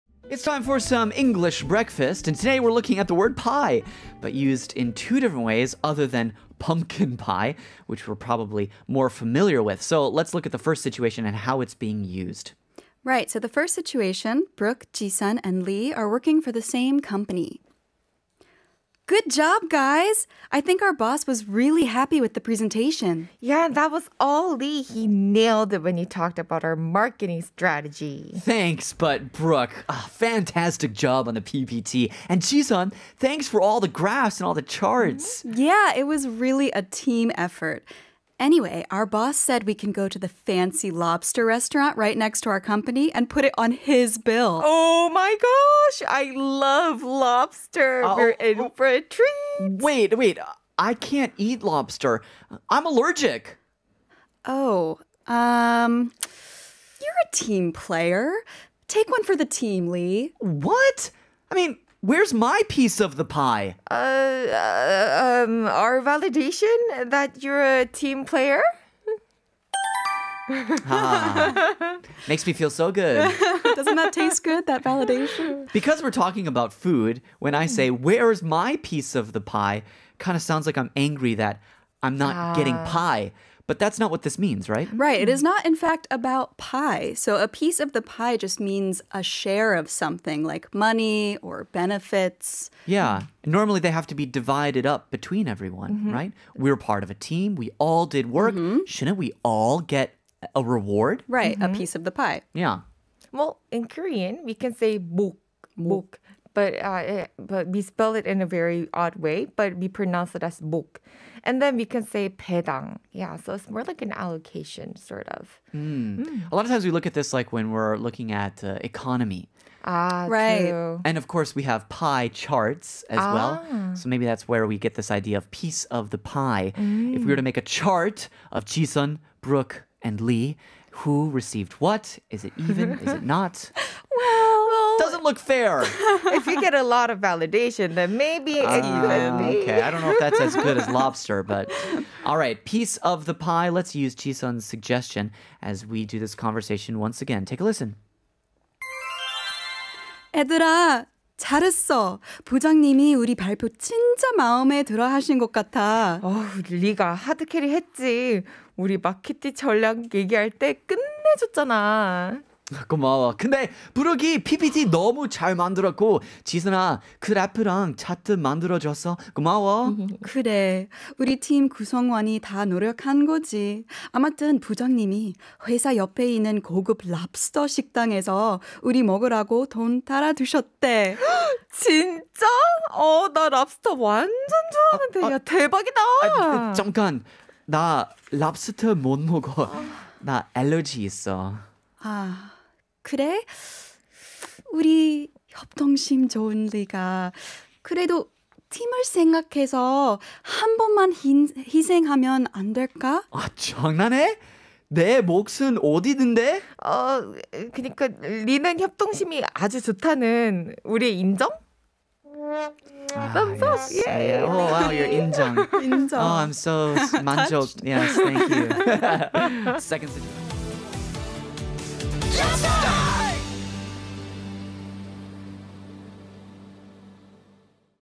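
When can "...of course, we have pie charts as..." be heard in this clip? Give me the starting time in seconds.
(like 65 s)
121 s.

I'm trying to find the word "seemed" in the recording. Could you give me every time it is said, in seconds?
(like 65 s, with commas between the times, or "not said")
not said.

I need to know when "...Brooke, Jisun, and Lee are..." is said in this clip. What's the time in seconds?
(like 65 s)
14 s.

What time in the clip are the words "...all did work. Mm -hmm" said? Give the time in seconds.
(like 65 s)
97 s.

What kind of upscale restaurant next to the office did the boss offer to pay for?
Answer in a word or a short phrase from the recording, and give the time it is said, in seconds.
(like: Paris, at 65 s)
lobster restaurant, at 40 s.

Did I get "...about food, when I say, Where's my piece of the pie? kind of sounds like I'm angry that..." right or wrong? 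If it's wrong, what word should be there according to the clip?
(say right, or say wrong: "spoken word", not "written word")
right.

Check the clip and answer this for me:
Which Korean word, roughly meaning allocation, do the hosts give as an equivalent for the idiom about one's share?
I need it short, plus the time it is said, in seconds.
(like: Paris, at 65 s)
배당, at 112 s.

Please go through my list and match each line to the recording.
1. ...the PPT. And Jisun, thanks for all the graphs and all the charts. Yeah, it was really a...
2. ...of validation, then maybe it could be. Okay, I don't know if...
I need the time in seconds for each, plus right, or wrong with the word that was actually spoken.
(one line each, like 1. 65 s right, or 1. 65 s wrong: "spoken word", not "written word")
1. 31 s right
2. 137 s right.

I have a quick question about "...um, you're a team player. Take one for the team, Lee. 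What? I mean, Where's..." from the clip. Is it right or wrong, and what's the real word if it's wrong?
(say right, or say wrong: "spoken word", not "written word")
right.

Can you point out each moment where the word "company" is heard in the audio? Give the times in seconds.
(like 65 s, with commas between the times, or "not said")
17 s, 42 s.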